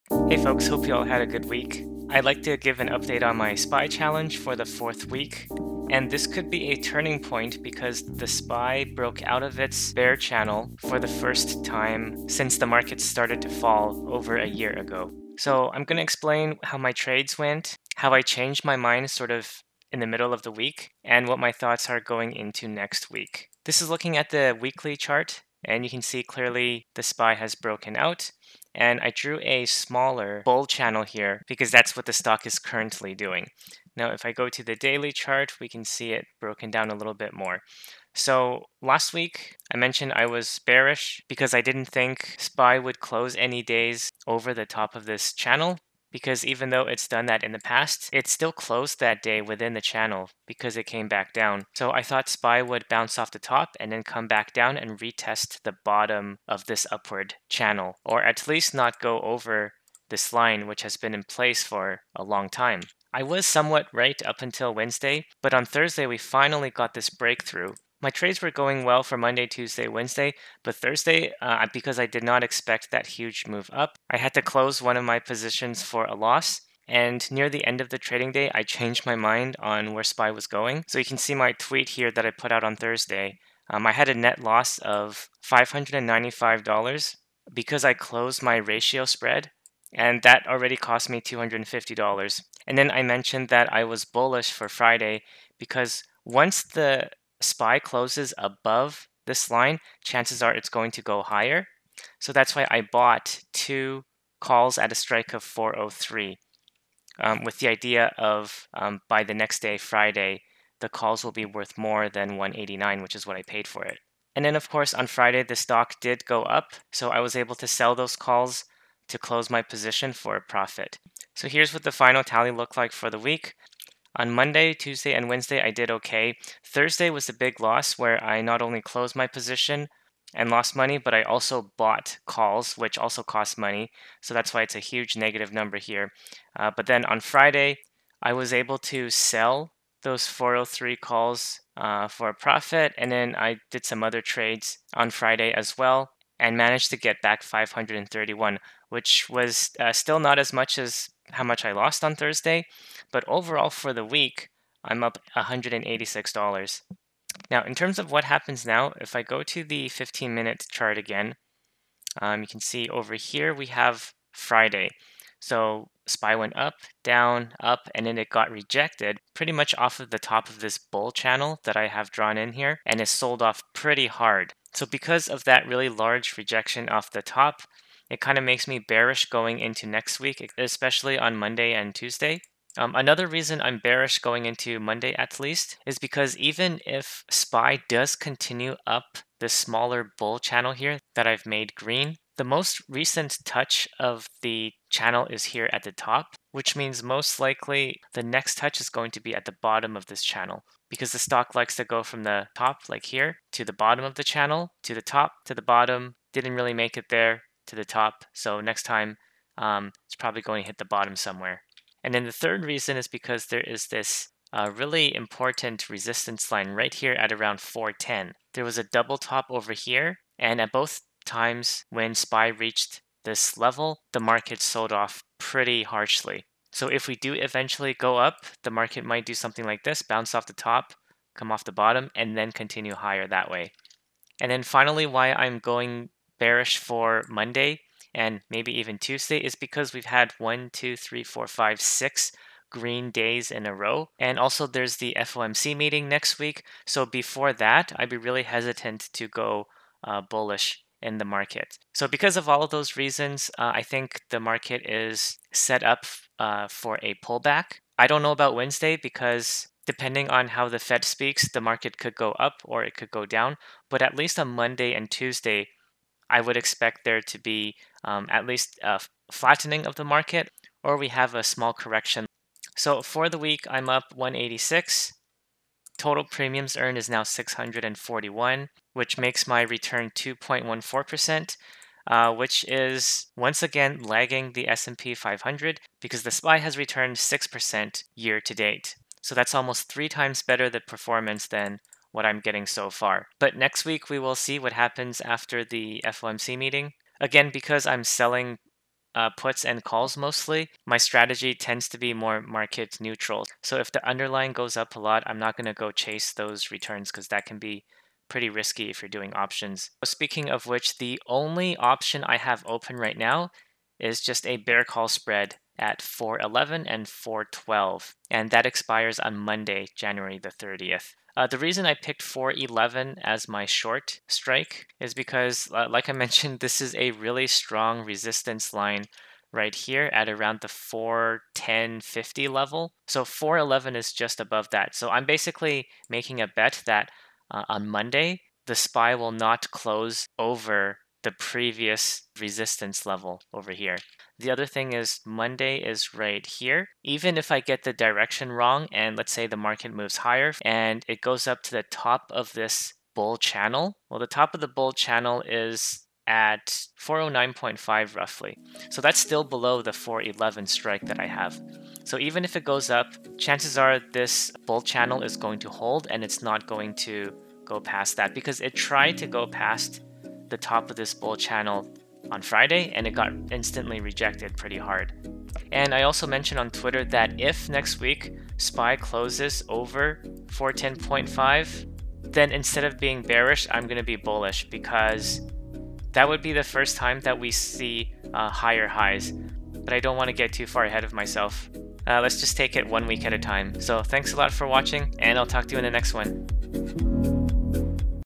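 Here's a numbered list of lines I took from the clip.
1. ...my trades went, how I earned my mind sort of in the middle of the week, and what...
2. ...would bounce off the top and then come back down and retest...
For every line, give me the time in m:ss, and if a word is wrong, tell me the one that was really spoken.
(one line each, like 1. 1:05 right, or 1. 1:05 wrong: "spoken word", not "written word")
1. 0:16 wrong: "changed", not "earned"
2. 0:52 right.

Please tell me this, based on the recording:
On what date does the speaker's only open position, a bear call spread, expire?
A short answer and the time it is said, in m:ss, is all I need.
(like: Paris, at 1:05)
January 30, at 5:19.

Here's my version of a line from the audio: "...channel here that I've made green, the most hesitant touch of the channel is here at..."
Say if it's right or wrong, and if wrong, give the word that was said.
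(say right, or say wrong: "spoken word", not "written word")
wrong: "recent", not "hesitant".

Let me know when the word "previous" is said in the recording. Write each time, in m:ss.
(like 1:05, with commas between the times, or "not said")
5:41.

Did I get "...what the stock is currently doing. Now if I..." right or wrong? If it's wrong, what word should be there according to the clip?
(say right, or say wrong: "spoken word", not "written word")
right.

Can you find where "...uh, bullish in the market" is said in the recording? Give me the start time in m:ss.
4:10.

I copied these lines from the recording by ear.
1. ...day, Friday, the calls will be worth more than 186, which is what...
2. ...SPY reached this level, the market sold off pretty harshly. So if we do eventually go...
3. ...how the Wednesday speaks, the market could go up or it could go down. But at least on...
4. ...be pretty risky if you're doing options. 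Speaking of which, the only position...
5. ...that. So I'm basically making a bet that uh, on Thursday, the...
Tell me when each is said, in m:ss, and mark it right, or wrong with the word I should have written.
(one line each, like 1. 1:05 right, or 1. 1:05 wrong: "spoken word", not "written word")
1. 1:49 wrong: "189", not "186"
2. 3:42 right
3. 4:20 wrong: "Fed", not "Wednesday"
4. 5:07 wrong: "option", not "position"
5. 5:34 wrong: "Monday", not "Thursday".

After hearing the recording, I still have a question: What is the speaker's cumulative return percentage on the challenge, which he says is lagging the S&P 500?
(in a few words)
2.14%.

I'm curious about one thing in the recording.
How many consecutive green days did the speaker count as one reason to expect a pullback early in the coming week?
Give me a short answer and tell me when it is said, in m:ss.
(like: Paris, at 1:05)
6, at 4:01.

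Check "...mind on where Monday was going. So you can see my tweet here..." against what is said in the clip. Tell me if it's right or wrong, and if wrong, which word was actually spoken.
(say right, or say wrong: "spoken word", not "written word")
wrong: "SPY", not "Monday".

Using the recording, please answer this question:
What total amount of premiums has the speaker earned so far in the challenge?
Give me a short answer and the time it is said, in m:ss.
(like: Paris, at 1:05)
641, at 4:37.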